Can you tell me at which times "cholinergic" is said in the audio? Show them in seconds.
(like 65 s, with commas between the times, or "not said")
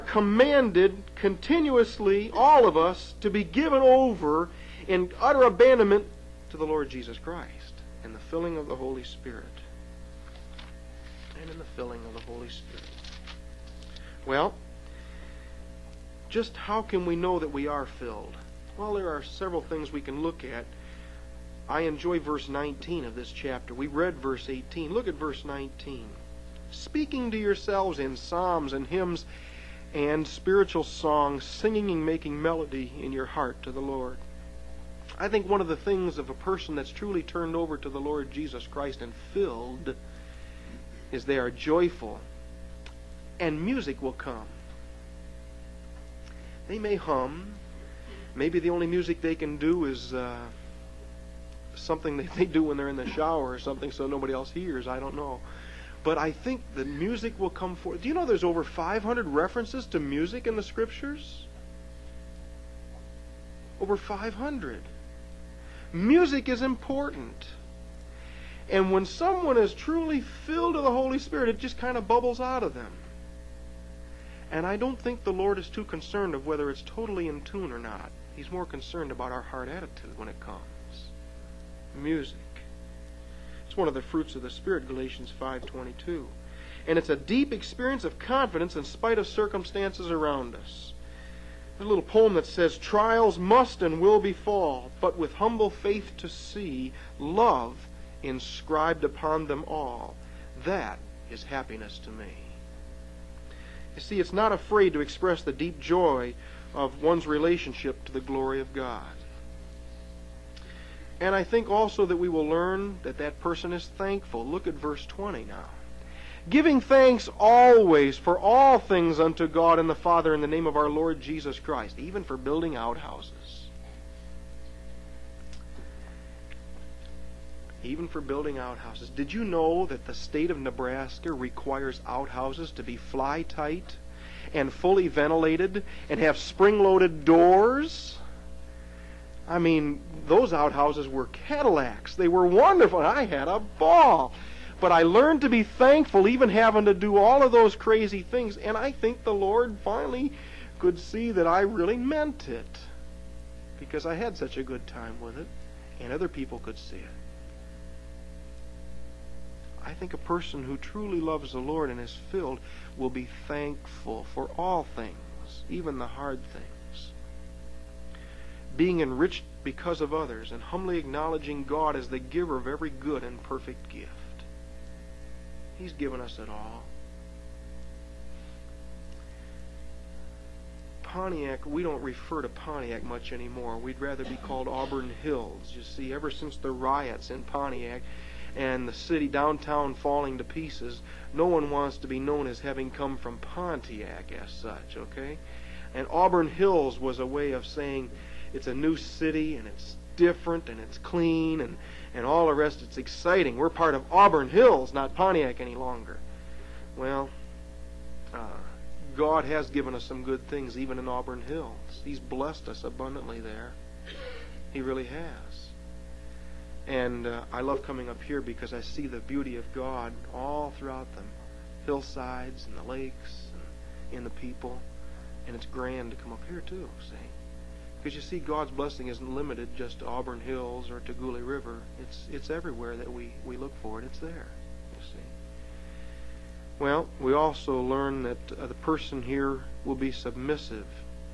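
not said.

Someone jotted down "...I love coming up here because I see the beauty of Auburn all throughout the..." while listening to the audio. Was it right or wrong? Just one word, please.
wrong.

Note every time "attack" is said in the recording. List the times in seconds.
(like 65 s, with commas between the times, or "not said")
not said.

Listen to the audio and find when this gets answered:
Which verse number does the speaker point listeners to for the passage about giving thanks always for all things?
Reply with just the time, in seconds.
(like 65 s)
114 s.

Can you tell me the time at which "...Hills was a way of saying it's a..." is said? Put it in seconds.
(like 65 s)
196 s.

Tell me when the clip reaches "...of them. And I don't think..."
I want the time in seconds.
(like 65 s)
72 s.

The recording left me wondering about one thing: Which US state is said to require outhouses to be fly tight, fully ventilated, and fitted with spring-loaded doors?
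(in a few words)
Nebraska.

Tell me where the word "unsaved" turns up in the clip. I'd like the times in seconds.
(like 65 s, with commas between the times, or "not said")
not said.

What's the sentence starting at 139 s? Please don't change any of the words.
I mean, those outhouses were Cadillacs.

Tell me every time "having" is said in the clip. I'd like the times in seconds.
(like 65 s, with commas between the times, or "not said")
146 s, 192 s.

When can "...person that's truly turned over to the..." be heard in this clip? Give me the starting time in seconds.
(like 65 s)
36 s.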